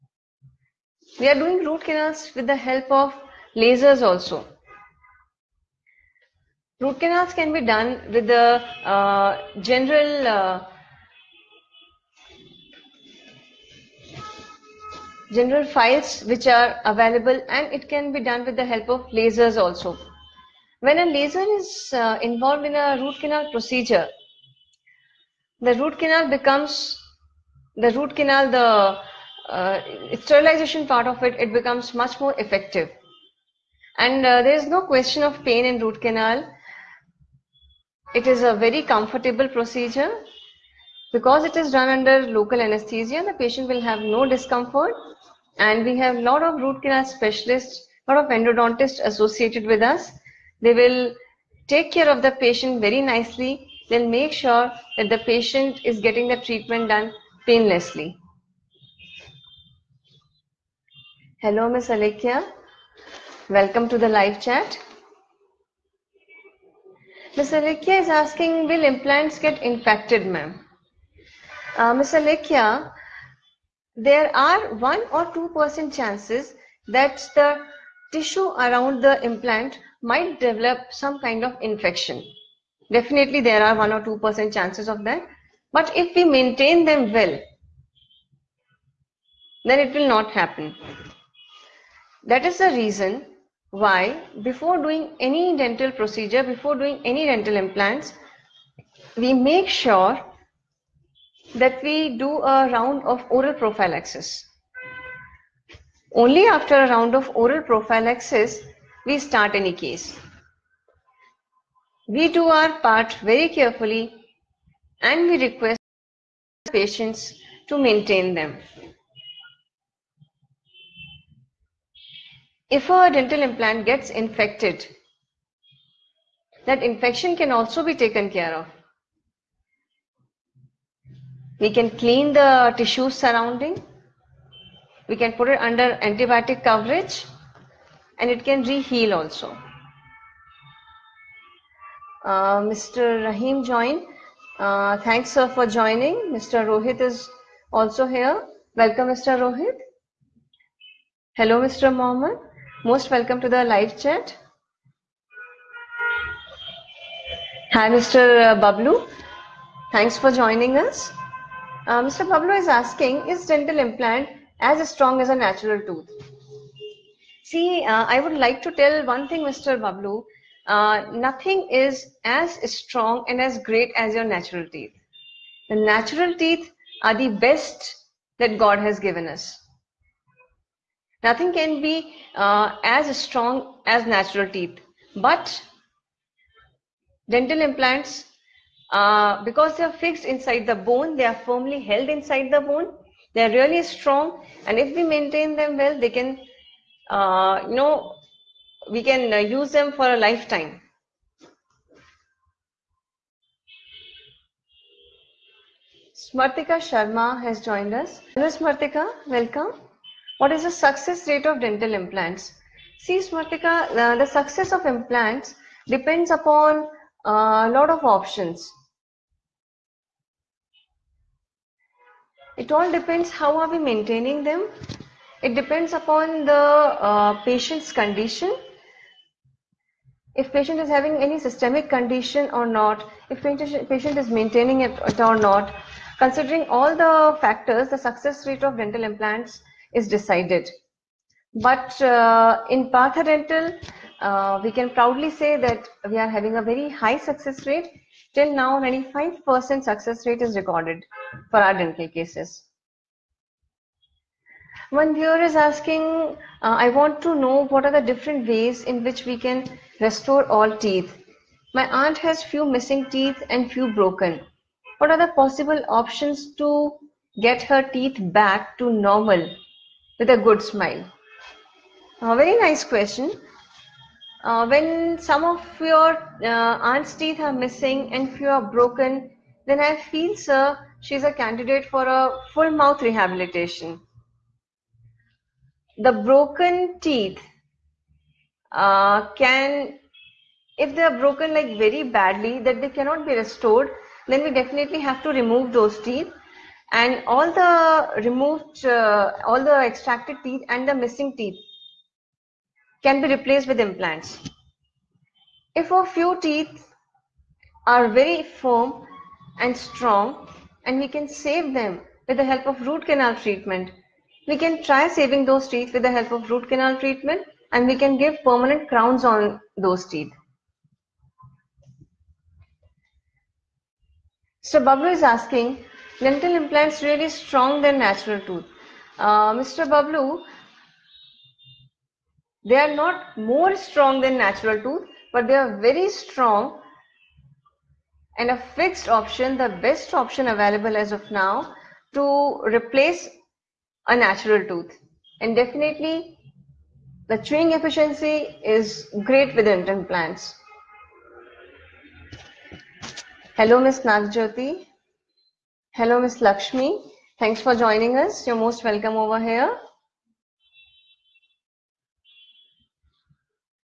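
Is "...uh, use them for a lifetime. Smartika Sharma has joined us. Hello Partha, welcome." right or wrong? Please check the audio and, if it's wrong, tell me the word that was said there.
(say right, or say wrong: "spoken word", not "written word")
wrong: "Smartika", not "Partha".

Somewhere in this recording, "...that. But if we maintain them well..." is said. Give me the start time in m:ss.
1:25.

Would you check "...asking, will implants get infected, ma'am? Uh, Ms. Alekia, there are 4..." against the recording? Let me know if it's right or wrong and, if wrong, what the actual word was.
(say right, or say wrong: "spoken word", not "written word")
wrong: "1", not "4".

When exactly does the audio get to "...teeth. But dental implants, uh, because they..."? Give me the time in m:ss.
3:04.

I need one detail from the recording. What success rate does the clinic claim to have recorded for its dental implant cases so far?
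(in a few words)
95%.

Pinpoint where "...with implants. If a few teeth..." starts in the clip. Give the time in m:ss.
5:03.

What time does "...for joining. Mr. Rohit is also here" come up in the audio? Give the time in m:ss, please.
2:25.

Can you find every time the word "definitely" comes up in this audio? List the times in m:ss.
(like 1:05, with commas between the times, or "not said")
1:22, 4:54, 5:45.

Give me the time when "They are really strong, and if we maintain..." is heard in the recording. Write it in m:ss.
3:13.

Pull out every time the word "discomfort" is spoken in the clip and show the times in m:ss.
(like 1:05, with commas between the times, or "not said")
0:44.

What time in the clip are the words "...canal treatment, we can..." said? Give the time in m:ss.
5:13.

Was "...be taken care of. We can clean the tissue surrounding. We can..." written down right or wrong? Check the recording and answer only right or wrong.
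right.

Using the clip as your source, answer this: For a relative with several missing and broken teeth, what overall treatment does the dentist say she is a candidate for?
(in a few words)
Full mouth rehabilitation.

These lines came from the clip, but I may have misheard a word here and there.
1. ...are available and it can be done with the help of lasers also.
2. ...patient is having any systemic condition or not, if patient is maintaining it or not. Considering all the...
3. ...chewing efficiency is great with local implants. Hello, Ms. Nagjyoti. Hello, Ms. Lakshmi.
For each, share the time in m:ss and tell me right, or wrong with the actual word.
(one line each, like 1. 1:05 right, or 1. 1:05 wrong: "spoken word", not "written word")
1. 0:16 right
2. 3:50 right
3. 5:47 wrong: "dental", not "local".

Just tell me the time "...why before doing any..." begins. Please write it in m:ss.
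1:33.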